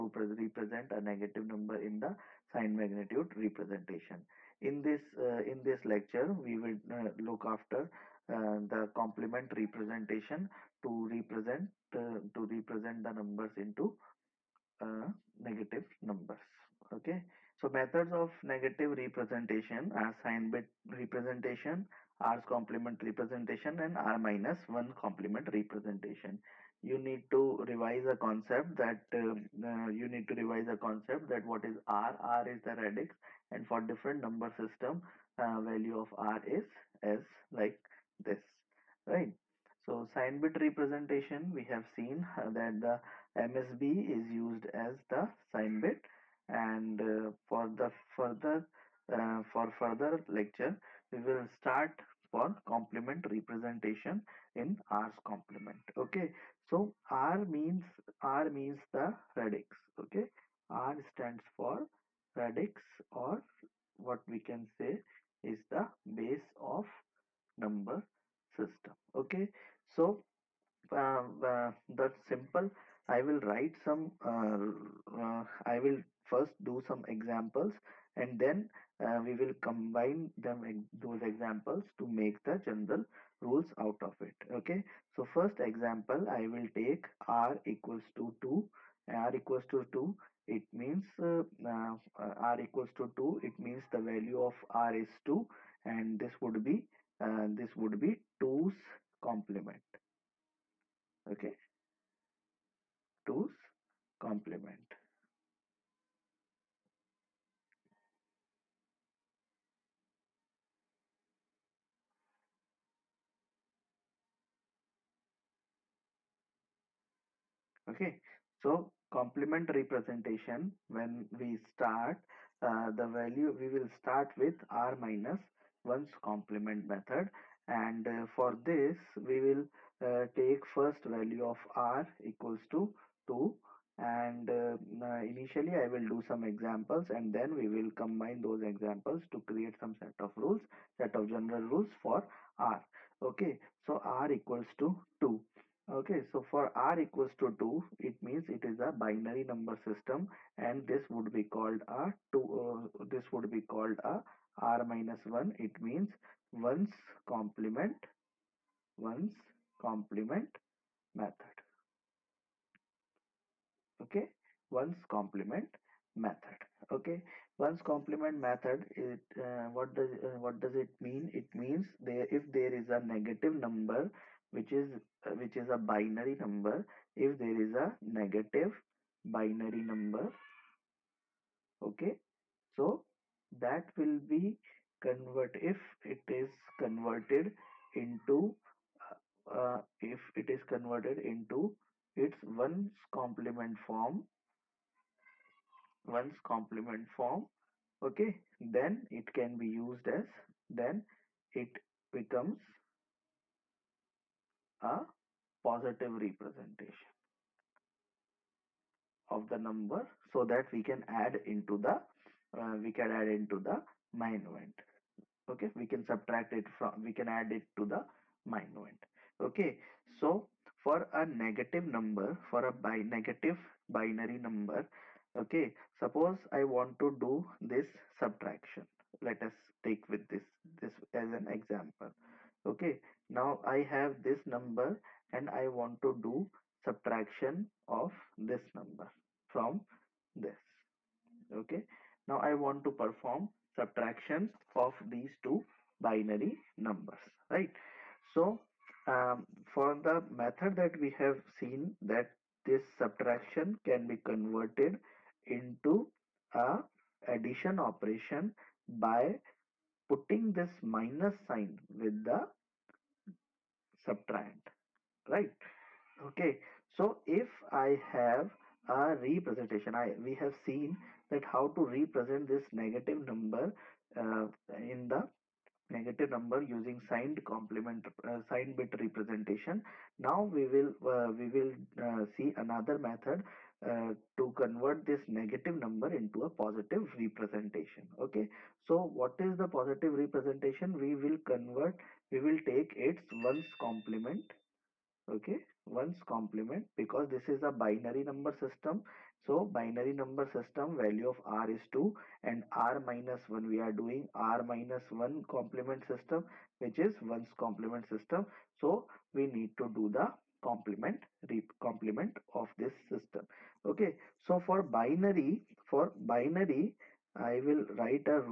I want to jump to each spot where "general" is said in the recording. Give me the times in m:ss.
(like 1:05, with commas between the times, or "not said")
1:22, 2:21.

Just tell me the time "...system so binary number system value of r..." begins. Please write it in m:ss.
4:58.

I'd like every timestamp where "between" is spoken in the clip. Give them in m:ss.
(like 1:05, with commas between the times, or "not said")
not said.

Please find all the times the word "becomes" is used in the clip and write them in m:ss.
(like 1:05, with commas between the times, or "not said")
3:22.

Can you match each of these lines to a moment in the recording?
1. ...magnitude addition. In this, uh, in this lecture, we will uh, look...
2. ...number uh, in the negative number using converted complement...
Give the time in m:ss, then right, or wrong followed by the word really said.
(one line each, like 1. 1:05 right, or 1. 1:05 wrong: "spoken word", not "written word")
1. 0:02 wrong: "representation", not "addition"
2. 4:33 wrong: "signed", not "converted".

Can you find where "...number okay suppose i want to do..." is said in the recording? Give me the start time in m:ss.
3:44.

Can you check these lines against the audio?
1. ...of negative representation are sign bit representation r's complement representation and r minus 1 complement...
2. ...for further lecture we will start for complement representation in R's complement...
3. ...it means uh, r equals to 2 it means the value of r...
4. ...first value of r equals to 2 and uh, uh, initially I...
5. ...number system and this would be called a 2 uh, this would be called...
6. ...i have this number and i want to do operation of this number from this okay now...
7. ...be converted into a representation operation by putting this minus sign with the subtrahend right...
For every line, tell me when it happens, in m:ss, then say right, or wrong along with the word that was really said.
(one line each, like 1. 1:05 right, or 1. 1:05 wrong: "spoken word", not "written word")
1. 0:18 right
2. 0:49 right
3. 1:30 right
4. 2:10 right
5. 2:29 right
6. 3:53 wrong: "subtraction", not "operation"
7. 4:14 wrong: "addition", not "representation".